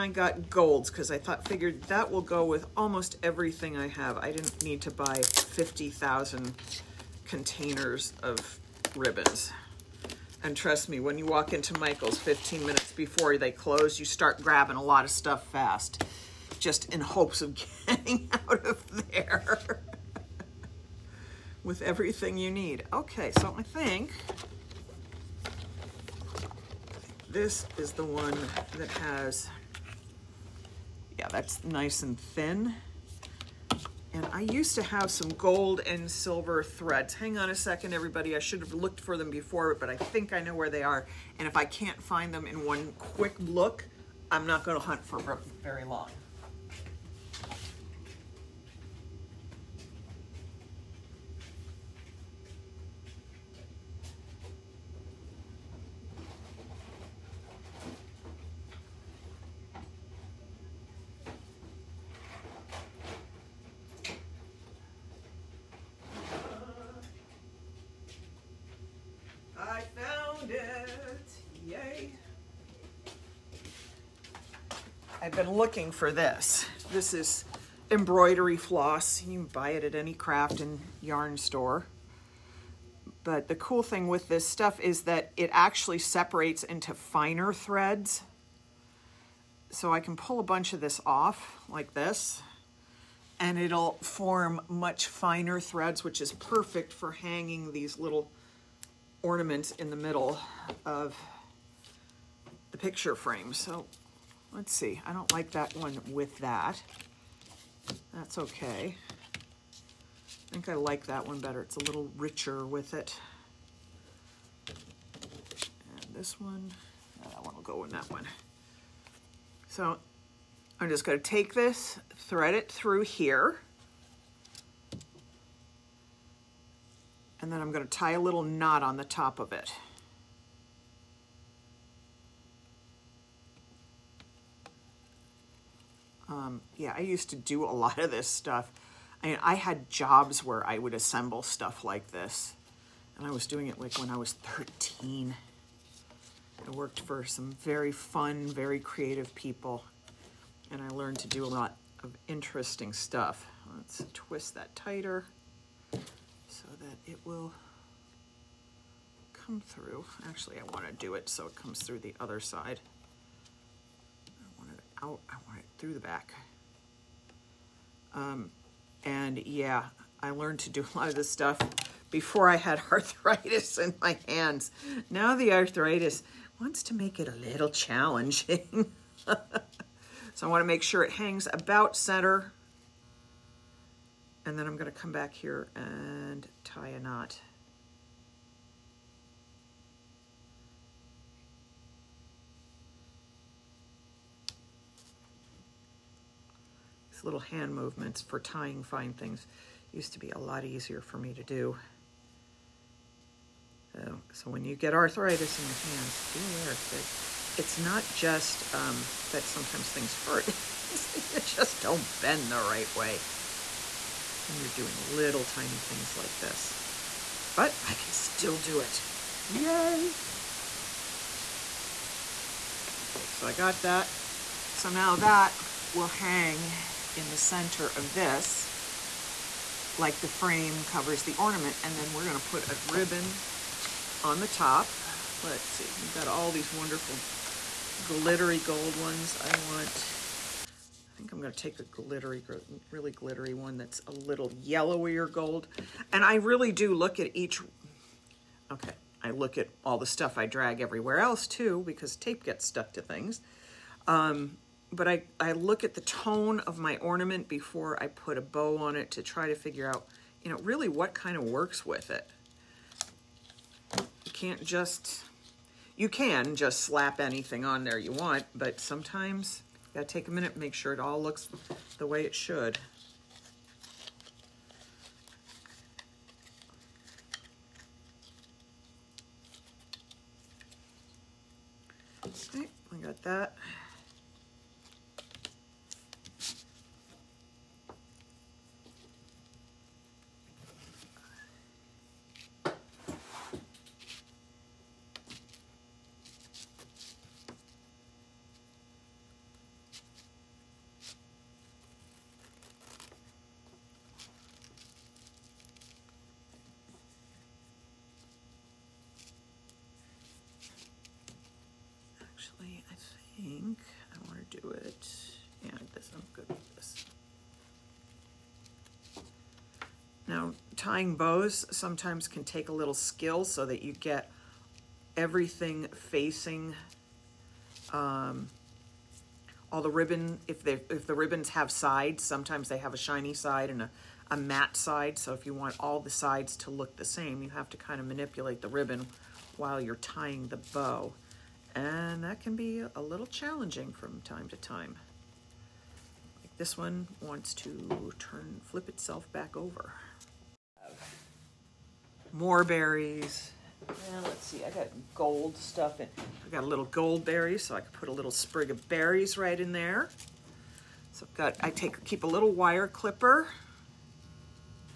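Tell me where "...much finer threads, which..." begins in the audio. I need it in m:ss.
1:34.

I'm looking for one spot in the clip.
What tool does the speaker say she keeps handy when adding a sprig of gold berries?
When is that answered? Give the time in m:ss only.
6:02.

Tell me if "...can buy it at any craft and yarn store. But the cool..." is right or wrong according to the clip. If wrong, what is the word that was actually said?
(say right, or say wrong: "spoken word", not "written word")
right.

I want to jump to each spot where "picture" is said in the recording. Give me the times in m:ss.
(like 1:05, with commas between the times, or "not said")
1:42.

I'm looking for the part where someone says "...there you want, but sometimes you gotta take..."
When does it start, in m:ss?
4:27.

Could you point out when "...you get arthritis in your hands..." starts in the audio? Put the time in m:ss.
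3:24.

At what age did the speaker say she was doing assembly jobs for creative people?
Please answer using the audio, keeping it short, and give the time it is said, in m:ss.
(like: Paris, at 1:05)
13, at 2:24.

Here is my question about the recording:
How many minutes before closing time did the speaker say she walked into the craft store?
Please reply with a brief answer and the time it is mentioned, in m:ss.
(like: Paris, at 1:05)
15, at 0:12.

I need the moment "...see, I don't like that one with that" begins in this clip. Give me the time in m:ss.
1:44.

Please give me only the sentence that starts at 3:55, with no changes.
Let's see, we've got all these wonderful glittery gold ones.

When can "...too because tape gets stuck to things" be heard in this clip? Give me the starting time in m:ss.
4:11.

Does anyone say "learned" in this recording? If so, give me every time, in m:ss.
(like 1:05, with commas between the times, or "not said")
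2:30, 2:50.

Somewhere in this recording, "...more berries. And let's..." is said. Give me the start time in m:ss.
5:52.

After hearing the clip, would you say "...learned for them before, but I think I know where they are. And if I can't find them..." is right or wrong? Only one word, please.
wrong.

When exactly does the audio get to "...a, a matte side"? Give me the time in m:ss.
5:33.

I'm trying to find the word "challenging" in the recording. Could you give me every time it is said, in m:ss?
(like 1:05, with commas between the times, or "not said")
2:57, 5:43.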